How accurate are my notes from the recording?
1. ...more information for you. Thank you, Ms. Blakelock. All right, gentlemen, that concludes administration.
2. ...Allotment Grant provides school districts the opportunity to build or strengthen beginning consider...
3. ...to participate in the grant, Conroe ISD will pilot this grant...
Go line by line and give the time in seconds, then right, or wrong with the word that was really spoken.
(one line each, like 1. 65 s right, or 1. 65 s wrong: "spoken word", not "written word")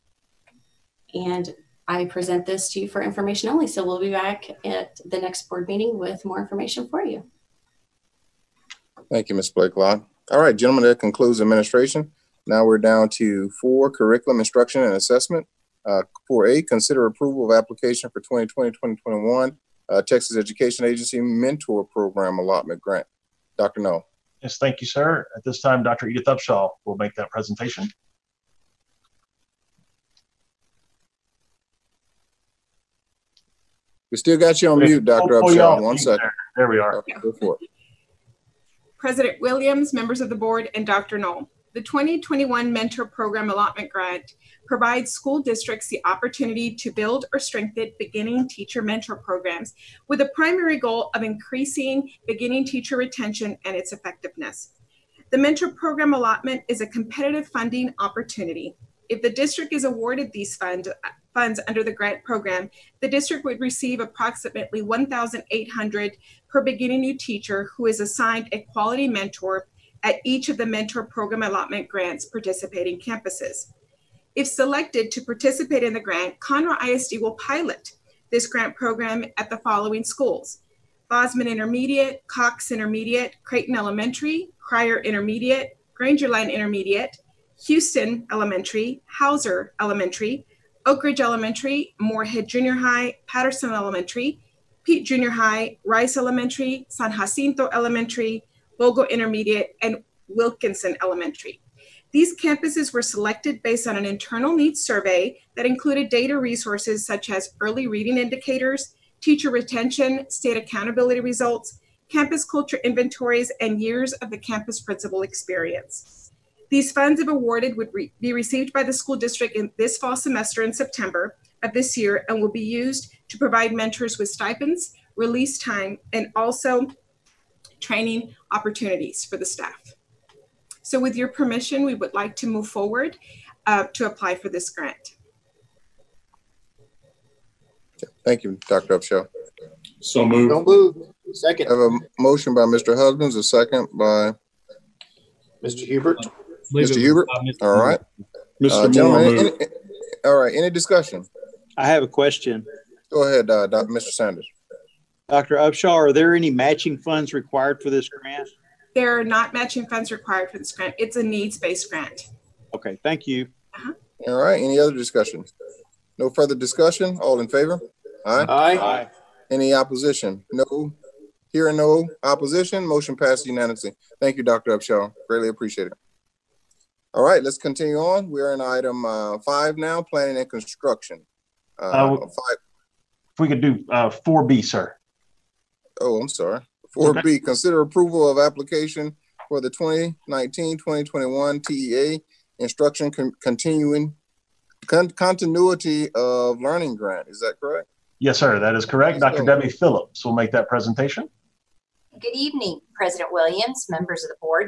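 1. 6 s right
2. 43 s wrong: "teacher", not "consider"
3. 75 s right.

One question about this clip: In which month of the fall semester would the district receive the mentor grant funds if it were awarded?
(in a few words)
September.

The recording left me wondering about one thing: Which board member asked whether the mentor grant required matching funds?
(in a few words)
Mr. Sanders.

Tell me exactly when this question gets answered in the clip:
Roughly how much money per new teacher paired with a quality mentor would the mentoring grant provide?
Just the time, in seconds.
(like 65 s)
64 s.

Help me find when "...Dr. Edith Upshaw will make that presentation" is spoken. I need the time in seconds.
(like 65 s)
25 s.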